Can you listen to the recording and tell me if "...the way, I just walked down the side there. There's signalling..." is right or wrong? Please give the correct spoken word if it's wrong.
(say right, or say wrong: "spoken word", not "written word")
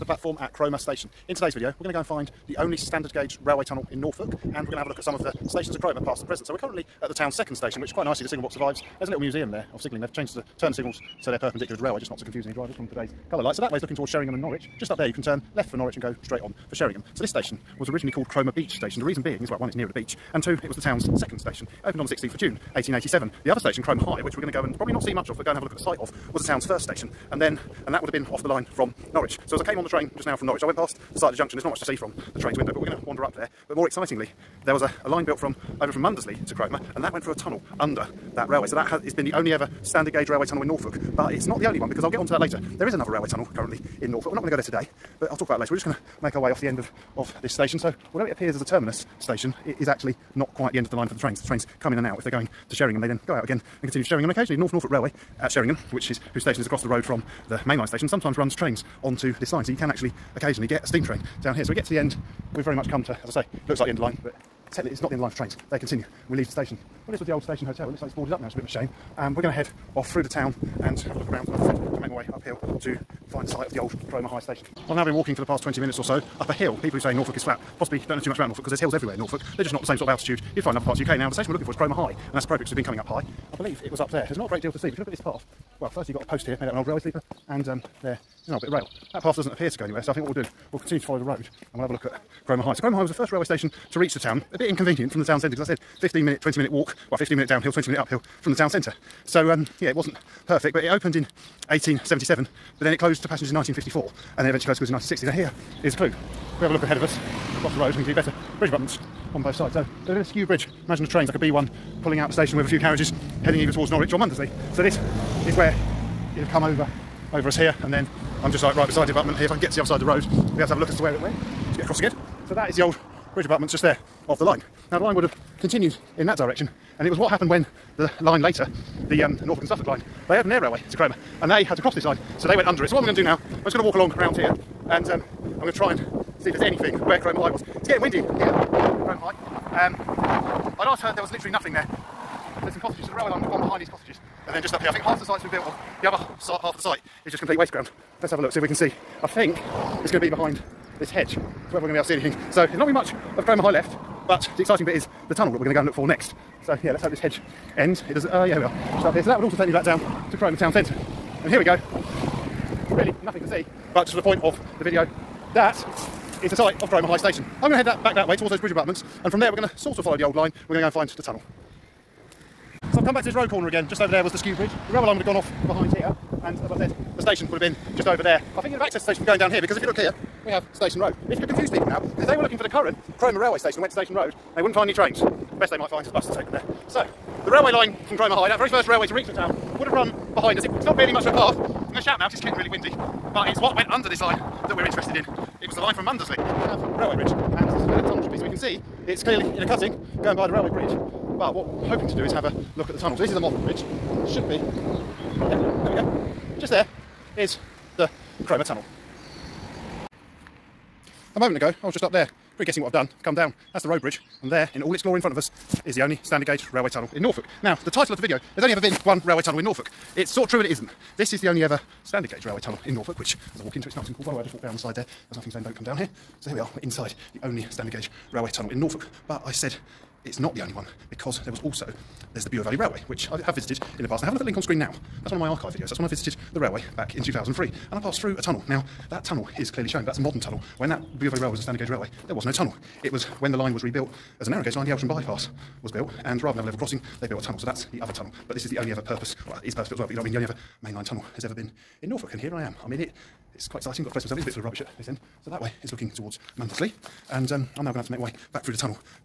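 wrong: "nothing", not "signalling".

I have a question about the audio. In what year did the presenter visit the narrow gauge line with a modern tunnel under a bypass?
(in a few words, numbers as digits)
2003.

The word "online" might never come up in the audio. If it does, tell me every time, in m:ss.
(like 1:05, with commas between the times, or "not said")
not said.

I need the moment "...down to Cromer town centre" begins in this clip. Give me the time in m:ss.
2:39.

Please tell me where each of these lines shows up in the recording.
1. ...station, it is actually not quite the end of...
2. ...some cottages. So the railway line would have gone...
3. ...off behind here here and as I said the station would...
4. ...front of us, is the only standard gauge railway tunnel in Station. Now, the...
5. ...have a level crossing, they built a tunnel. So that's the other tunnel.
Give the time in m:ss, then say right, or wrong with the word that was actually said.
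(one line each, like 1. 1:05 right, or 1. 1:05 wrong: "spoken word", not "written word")
1. 0:49 right
2. 2:22 right
3. 2:55 right
4. 3:35 wrong: "Norfolk", not "Station"
5. 4:06 right.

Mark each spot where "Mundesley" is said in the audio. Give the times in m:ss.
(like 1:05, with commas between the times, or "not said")
0:36, 1:54, 3:16, 4:16.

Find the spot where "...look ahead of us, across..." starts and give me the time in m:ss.
1:46.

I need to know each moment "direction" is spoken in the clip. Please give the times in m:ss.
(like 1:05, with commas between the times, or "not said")
2:06.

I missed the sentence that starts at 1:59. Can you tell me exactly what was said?
If I can get to the other side of the road, we have to have a look as to where it went.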